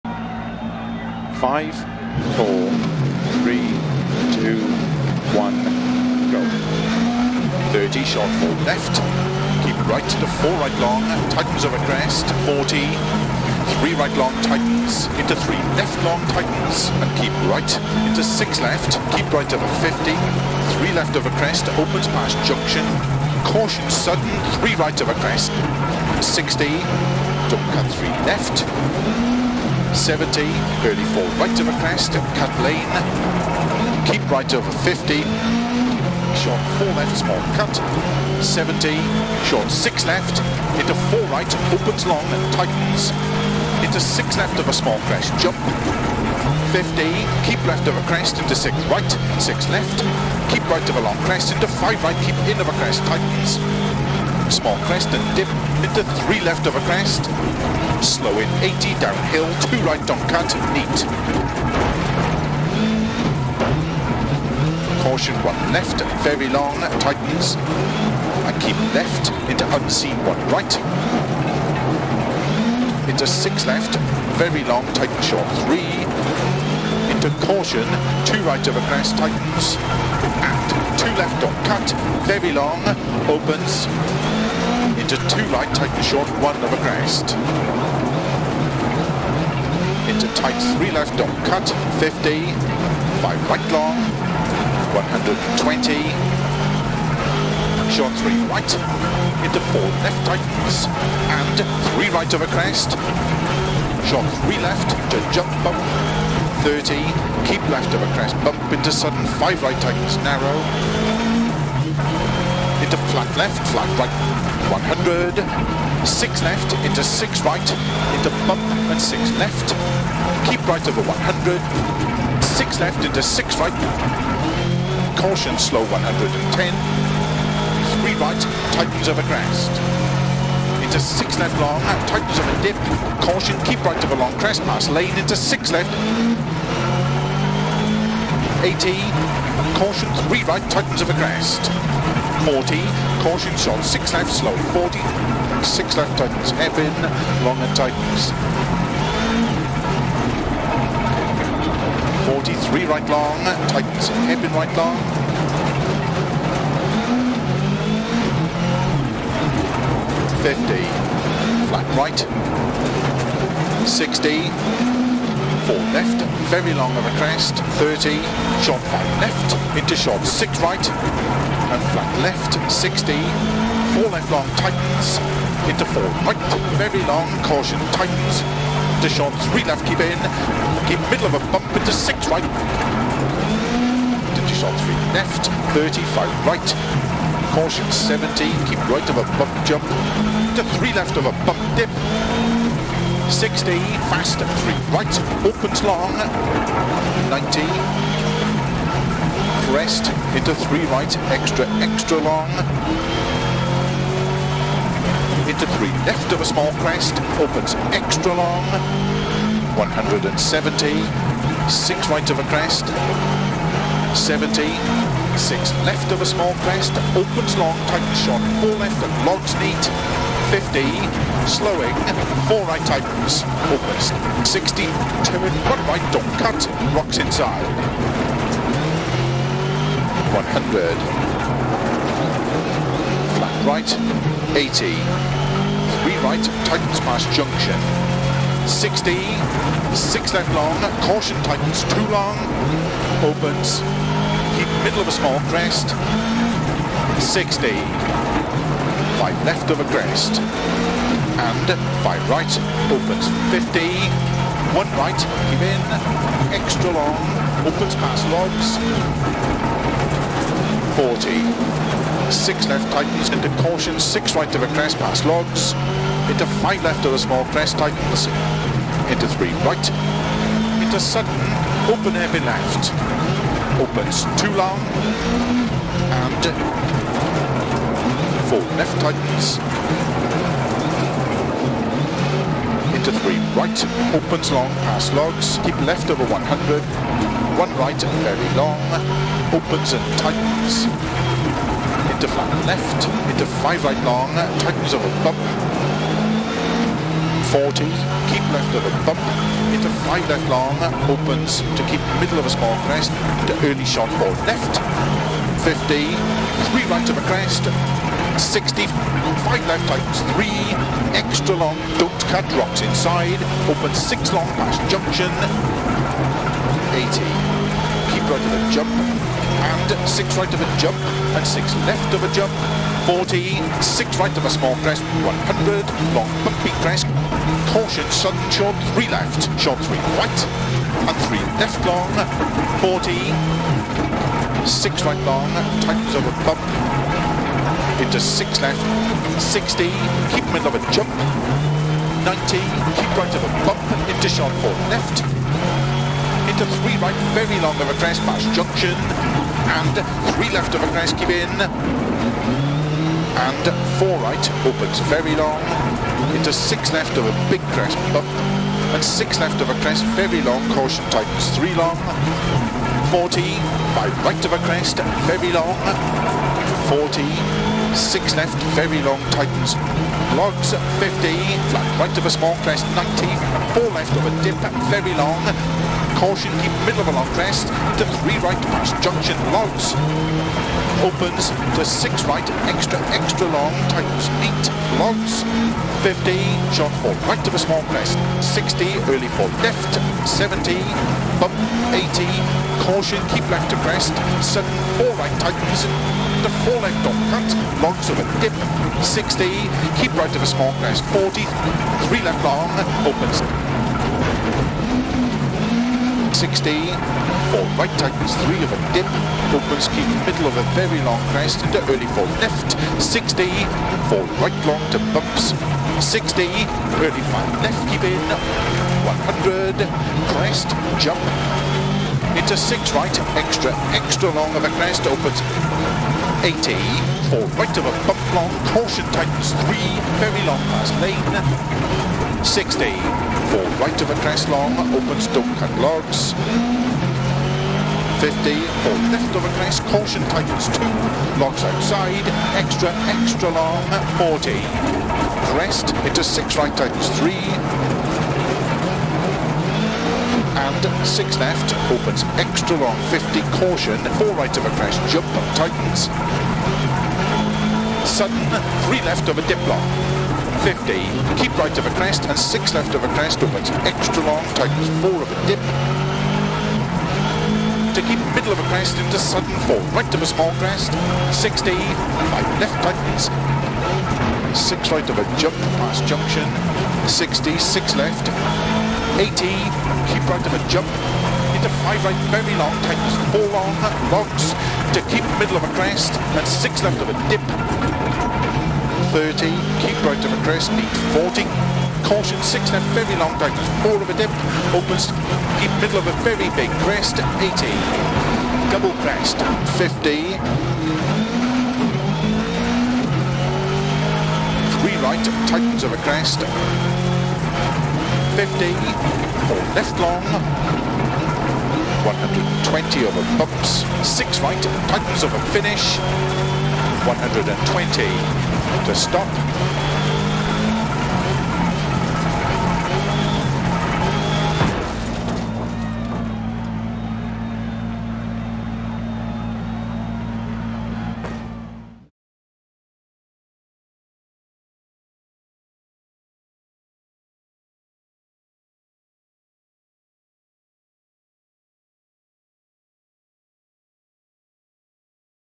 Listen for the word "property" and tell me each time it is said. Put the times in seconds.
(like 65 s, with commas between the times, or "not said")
not said.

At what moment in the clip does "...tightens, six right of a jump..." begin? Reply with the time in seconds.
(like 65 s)
472 s.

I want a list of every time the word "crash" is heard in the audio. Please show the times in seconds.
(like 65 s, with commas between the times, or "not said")
454 s.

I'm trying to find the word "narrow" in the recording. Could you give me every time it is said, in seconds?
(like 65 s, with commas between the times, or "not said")
110 s.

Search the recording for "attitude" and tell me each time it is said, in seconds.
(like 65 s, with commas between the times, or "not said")
not said.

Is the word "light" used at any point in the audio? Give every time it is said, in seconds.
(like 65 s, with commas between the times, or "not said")
85 s.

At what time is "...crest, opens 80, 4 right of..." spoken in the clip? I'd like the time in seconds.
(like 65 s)
424 s.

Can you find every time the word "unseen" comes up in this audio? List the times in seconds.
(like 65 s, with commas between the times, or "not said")
69 s.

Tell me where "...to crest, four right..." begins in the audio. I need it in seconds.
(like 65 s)
393 s.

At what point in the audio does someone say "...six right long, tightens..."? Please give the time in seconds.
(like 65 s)
334 s.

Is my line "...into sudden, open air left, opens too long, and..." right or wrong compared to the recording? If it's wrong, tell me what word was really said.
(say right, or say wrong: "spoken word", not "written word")
right.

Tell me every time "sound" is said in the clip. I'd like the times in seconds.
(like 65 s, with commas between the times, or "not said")
not said.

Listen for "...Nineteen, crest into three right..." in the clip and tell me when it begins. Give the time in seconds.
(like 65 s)
197 s.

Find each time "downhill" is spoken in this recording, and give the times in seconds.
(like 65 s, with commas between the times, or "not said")
58 s.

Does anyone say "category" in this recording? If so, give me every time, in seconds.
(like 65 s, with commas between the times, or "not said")
not said.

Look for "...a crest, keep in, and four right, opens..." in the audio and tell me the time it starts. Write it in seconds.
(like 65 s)
350 s.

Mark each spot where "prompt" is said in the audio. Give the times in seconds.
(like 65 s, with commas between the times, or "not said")
not said.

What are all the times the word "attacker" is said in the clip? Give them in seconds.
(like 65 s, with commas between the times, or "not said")
not said.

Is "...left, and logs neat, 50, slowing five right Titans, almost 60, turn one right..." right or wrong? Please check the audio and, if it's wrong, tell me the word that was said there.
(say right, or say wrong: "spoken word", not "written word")
wrong: "four", not "five".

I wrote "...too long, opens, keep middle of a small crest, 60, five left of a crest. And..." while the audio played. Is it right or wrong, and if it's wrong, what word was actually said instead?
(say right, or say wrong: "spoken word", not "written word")
right.